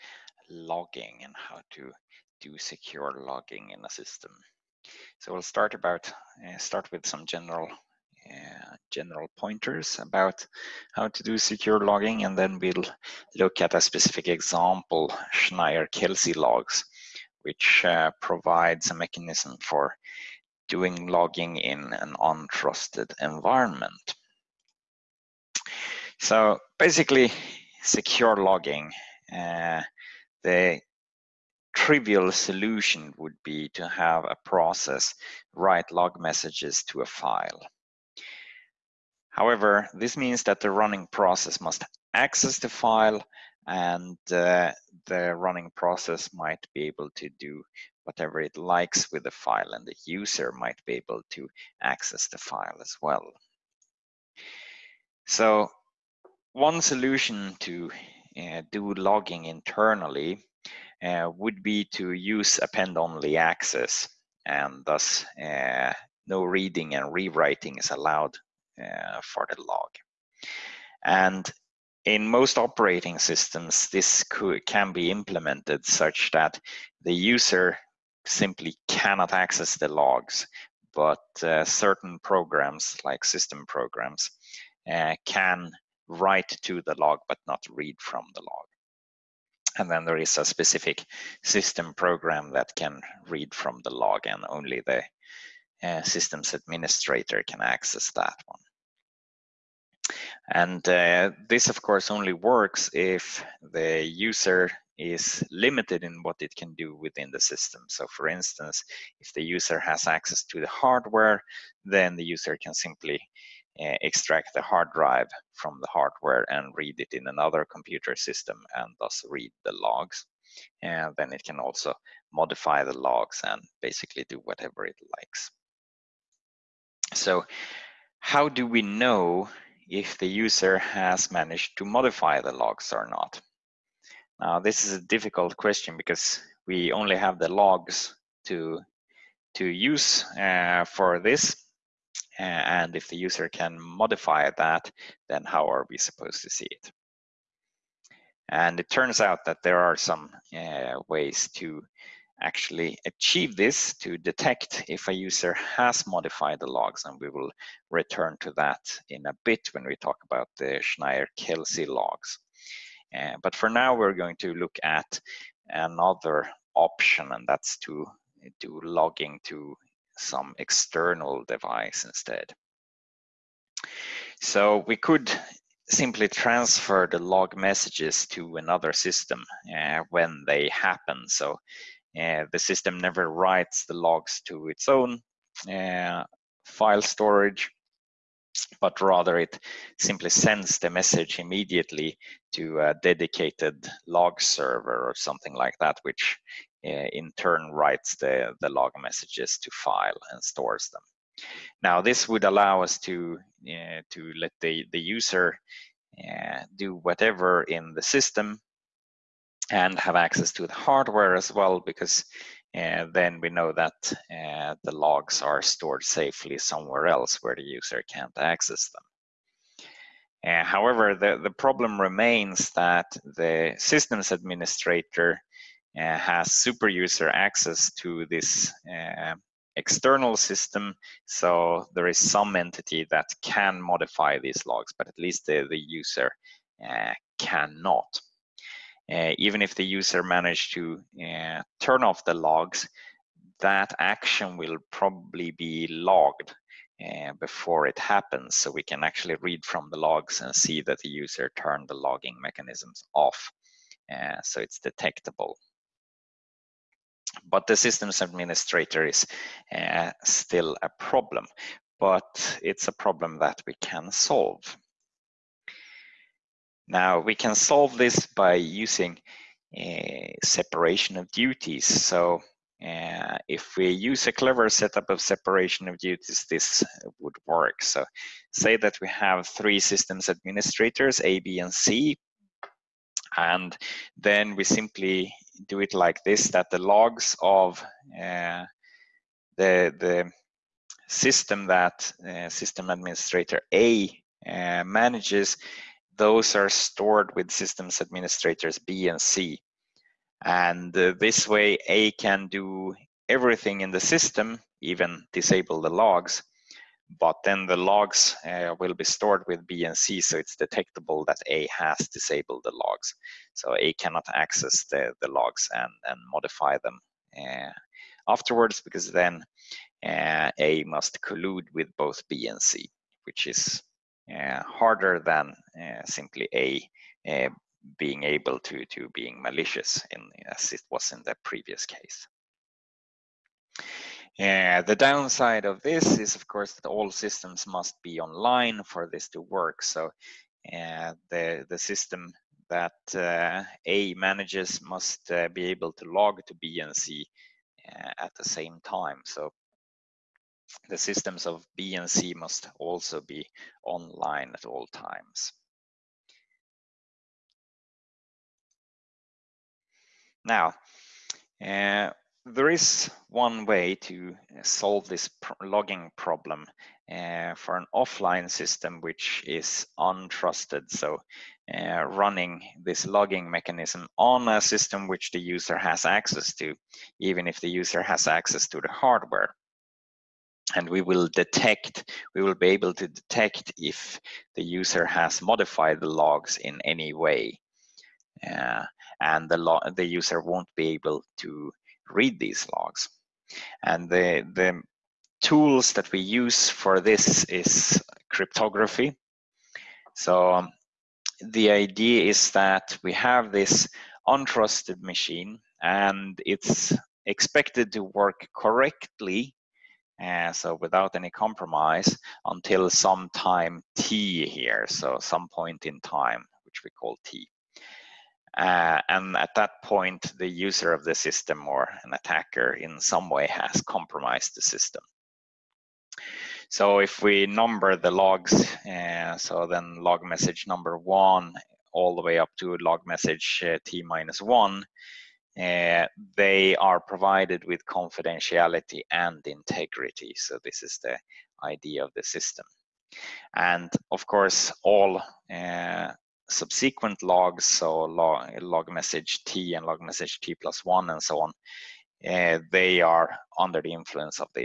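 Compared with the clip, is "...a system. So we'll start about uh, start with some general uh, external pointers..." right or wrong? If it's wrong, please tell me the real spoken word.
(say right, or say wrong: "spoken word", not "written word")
wrong: "general", not "external".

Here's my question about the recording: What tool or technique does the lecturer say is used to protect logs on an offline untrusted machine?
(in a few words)
Cryptography.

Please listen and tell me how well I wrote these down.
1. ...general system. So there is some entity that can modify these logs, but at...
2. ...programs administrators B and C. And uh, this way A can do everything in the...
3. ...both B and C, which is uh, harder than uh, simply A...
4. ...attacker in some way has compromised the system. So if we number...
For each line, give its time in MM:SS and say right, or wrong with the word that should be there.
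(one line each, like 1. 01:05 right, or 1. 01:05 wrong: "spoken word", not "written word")
1. 03:49 wrong: "external", not "general"
2. 04:57 wrong: "systems", not "programs"
3. 05:21 right
4. 07:02 right.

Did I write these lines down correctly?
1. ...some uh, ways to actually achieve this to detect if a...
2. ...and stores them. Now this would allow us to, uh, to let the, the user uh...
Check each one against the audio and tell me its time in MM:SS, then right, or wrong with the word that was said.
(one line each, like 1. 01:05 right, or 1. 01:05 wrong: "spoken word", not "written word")
1. 02:29 right
2. 03:20 right.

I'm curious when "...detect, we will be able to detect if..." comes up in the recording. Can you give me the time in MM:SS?
06:21.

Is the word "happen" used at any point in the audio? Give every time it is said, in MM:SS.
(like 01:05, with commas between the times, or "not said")
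03:00, 04:07.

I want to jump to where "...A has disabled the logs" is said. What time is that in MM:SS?
05:11.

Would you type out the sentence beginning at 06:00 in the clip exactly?
Now, uh, there is one way to uh, solve this logging problem uh, for an offline system which is untrusted.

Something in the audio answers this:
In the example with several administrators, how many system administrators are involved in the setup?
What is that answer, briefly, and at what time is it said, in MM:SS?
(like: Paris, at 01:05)
3, at 04:39.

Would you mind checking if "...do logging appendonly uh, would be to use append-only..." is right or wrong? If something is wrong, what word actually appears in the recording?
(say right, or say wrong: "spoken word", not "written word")
wrong: "internally", not "appendonly".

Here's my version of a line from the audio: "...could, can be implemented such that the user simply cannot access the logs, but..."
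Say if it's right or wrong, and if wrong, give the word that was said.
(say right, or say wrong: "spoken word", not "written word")
right.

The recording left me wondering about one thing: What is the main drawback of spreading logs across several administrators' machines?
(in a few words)
All systems must be online.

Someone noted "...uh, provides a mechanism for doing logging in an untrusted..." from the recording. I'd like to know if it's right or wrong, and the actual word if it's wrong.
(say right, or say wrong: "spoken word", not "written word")
right.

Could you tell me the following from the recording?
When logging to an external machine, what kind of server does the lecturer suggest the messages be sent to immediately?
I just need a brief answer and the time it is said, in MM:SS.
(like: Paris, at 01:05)
Dedicated log server, at 03:13.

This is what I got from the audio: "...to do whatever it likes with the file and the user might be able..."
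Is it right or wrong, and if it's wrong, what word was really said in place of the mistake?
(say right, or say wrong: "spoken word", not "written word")
right.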